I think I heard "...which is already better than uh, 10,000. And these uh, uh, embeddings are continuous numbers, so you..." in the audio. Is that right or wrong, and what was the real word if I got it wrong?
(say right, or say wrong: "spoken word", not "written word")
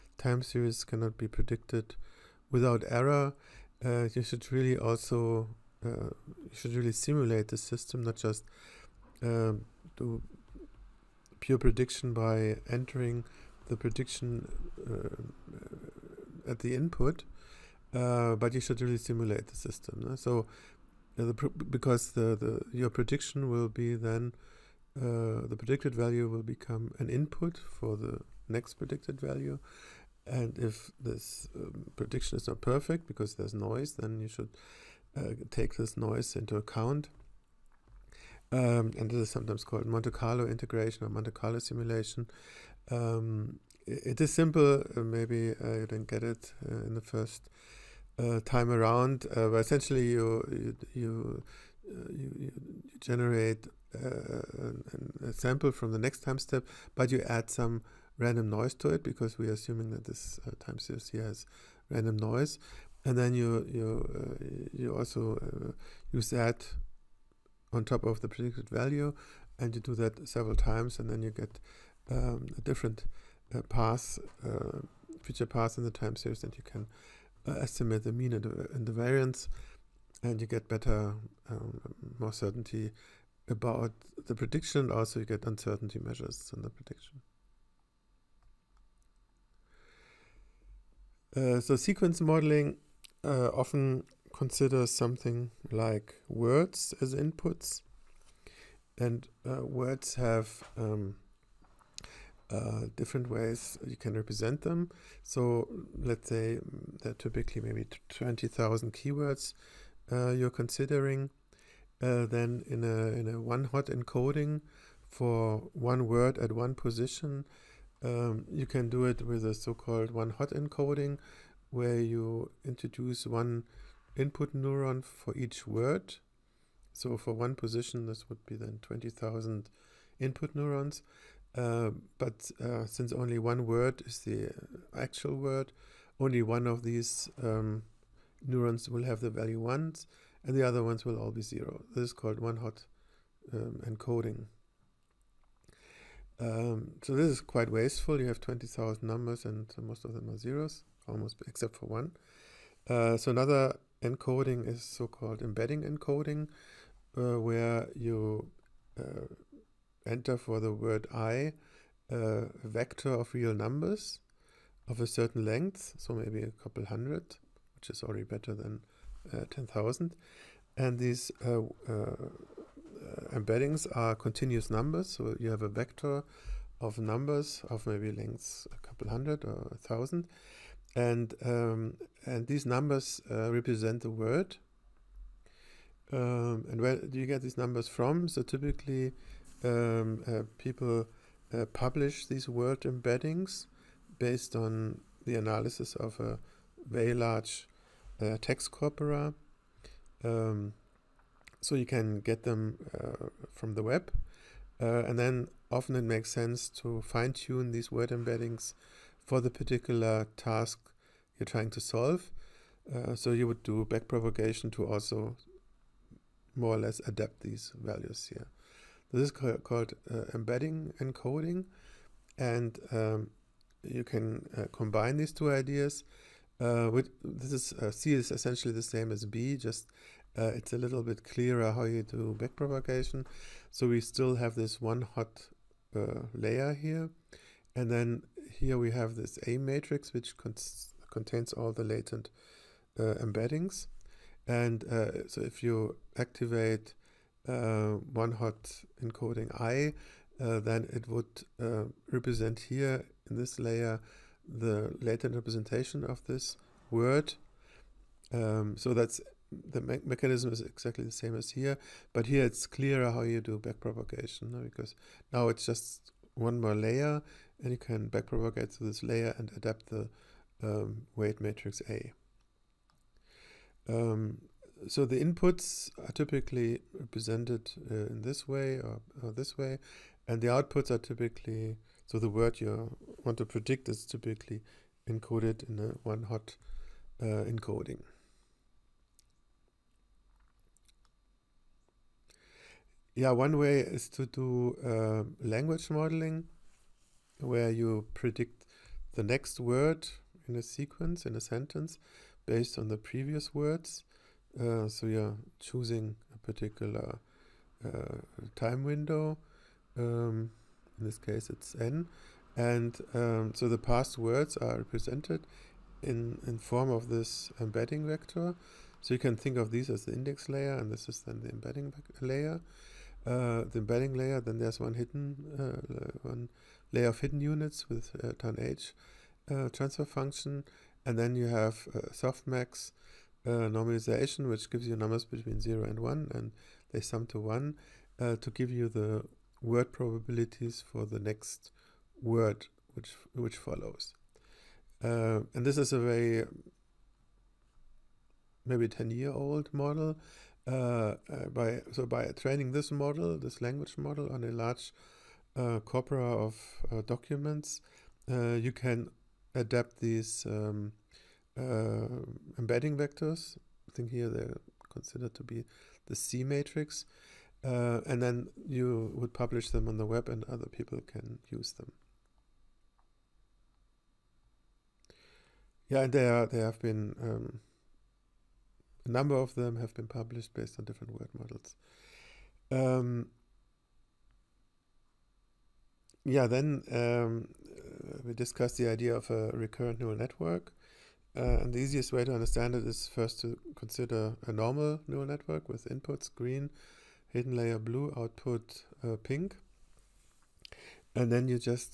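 right.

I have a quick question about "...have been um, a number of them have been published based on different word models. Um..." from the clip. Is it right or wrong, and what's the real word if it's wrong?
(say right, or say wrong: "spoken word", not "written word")
right.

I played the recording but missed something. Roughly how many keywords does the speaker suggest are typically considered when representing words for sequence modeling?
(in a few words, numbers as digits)
20,000.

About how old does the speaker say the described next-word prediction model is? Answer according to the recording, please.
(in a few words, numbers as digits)
10 years.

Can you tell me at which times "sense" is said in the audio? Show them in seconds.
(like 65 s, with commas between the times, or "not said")
206 s.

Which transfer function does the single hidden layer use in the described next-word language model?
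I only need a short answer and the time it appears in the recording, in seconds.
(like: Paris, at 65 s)
tanh, at 328 s.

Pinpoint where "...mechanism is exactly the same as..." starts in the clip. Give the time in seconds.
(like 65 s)
260 s.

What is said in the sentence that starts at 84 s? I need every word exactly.
Also, you get uncertainty measures in the prediction.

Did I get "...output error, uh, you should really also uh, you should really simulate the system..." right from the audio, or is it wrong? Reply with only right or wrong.
wrong.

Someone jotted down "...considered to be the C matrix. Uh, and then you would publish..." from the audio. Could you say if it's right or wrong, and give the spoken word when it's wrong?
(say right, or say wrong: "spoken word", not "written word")
right.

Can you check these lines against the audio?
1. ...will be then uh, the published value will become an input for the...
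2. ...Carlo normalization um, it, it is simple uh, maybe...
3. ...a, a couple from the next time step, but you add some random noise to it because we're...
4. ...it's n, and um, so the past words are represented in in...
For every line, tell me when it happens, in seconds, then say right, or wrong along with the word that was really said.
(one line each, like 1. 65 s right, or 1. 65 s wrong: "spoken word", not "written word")
1. 23 s wrong: "predicted", not "published"
2. 41 s wrong: "simulation", not "normalization"
3. 55 s wrong: "sample", not "couple"
4. 311 s right.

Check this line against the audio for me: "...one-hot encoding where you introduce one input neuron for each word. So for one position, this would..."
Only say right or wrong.
right.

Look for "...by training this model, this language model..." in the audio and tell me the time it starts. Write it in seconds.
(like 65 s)
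352 s.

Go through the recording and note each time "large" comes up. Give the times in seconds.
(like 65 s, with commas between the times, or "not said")
197 s, 354 s.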